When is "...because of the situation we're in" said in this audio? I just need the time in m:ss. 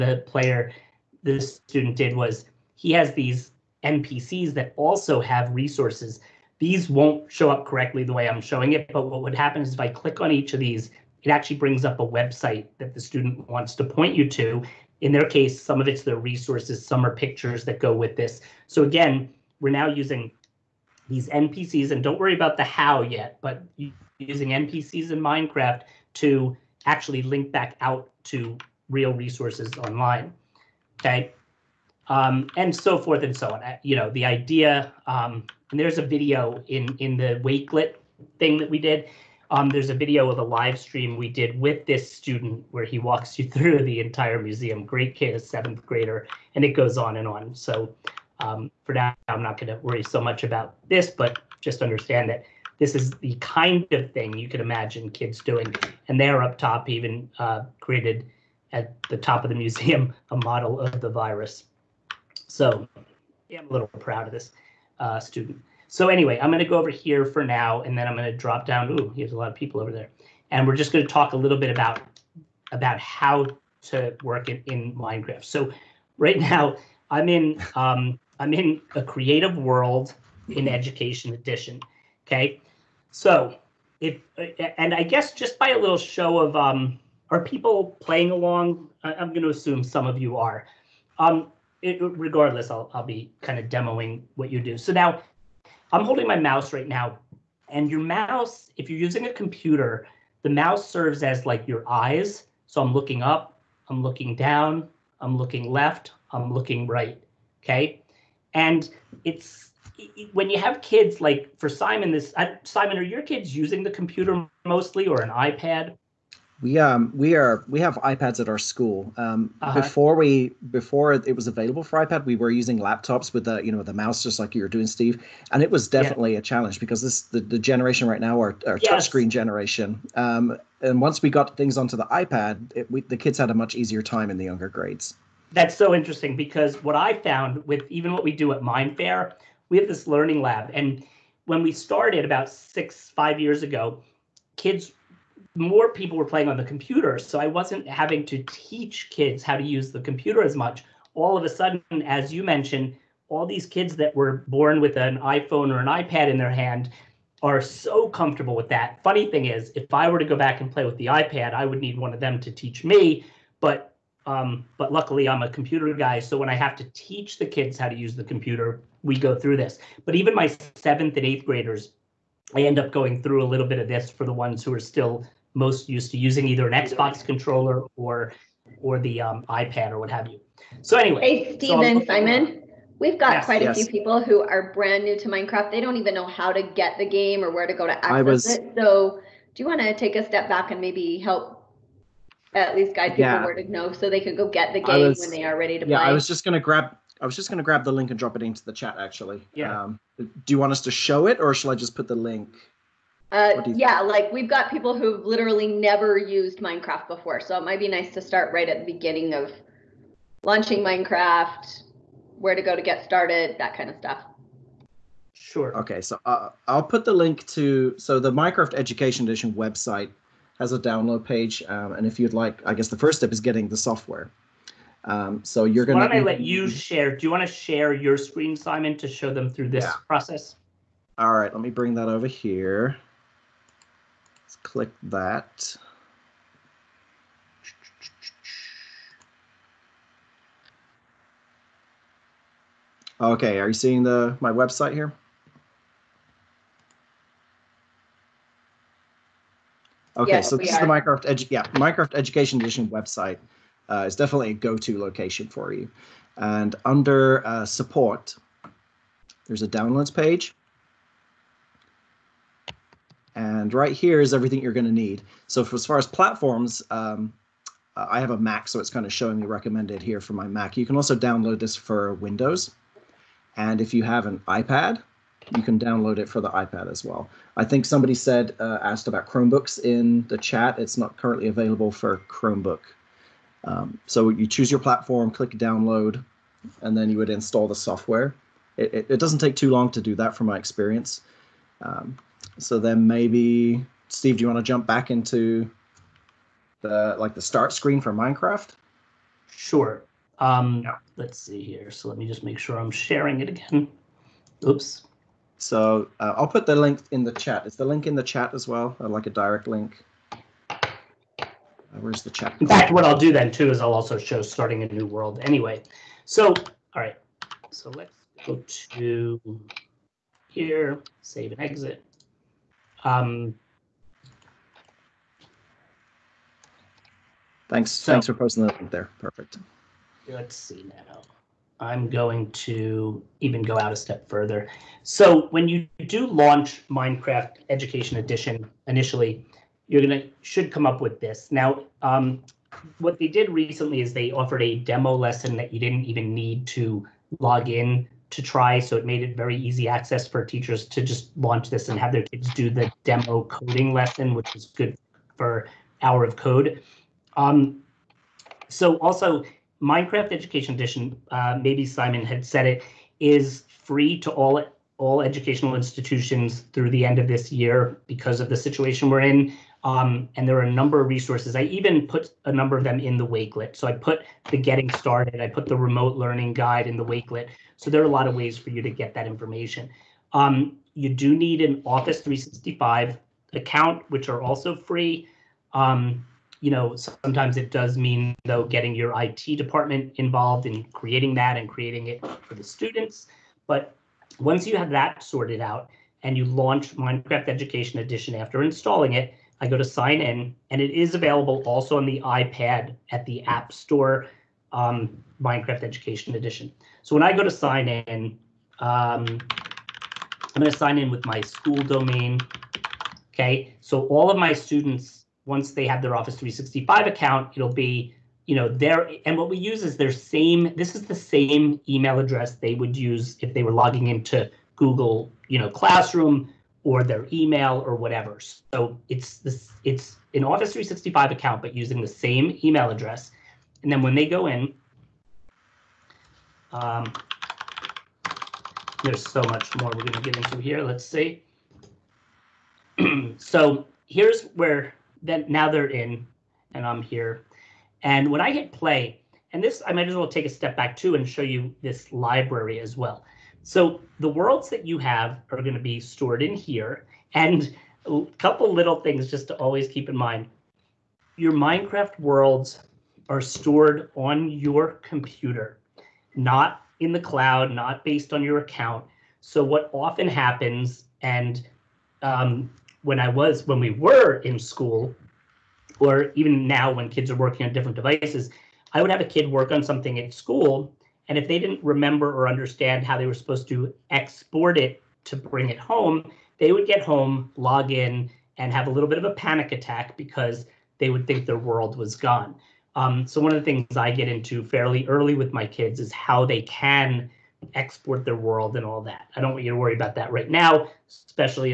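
6:08.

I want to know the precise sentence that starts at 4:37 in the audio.
I think somebody said uh, asked about Chromebooks in the chat.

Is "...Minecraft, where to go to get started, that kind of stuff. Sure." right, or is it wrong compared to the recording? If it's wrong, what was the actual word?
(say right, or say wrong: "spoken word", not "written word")
right.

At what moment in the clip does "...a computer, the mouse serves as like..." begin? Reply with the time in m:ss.
1:39.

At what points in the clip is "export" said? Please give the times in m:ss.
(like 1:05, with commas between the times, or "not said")
8:04, 8:17.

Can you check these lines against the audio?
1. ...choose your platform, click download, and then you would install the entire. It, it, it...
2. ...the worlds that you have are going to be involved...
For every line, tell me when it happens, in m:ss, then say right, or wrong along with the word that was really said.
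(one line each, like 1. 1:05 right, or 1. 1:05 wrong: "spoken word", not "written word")
1. 4:44 wrong: "software", not "entire"
2. 7:34 wrong: "stored", not "involved".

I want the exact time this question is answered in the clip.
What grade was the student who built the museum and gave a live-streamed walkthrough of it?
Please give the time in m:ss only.
0:45.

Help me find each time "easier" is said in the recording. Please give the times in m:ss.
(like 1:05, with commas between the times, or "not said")
2:13.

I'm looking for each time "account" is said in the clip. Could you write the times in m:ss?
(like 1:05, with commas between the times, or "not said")
6:23, 6:57, 7:11, 7:48.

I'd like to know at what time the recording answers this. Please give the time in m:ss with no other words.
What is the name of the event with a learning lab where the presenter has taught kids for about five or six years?
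2:18.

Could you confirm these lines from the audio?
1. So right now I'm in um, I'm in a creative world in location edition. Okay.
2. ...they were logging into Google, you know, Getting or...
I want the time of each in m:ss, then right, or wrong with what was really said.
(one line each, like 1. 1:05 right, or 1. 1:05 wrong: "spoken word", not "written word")
1. 1:15 wrong: "education", not "location"
2. 7:03 wrong: "Classroom", not "Getting".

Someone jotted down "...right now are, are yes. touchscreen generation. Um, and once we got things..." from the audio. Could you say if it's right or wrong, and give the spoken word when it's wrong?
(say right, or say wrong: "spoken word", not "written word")
right.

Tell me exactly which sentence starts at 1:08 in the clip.
Ooh, there's a lot of people over there.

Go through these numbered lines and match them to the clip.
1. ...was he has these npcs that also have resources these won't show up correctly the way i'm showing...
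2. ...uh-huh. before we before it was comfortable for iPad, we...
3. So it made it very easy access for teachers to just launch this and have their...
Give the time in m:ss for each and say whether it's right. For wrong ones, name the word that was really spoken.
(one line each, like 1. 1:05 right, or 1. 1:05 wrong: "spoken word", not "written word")
1. 0:02 right
2. 1:59 wrong: "available", not "comfortable"
3. 5:48 right.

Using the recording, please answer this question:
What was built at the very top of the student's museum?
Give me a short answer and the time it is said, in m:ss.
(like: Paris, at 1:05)
A model of the virus, at 1:01.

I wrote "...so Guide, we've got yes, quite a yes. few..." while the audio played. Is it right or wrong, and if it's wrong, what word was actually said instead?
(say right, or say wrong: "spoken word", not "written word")
wrong: "Simon", not "Guide".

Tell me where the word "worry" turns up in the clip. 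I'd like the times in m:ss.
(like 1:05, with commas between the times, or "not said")
0:22, 0:49, 8:19.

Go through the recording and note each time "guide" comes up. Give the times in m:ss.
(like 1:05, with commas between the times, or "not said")
3:12, 6:16.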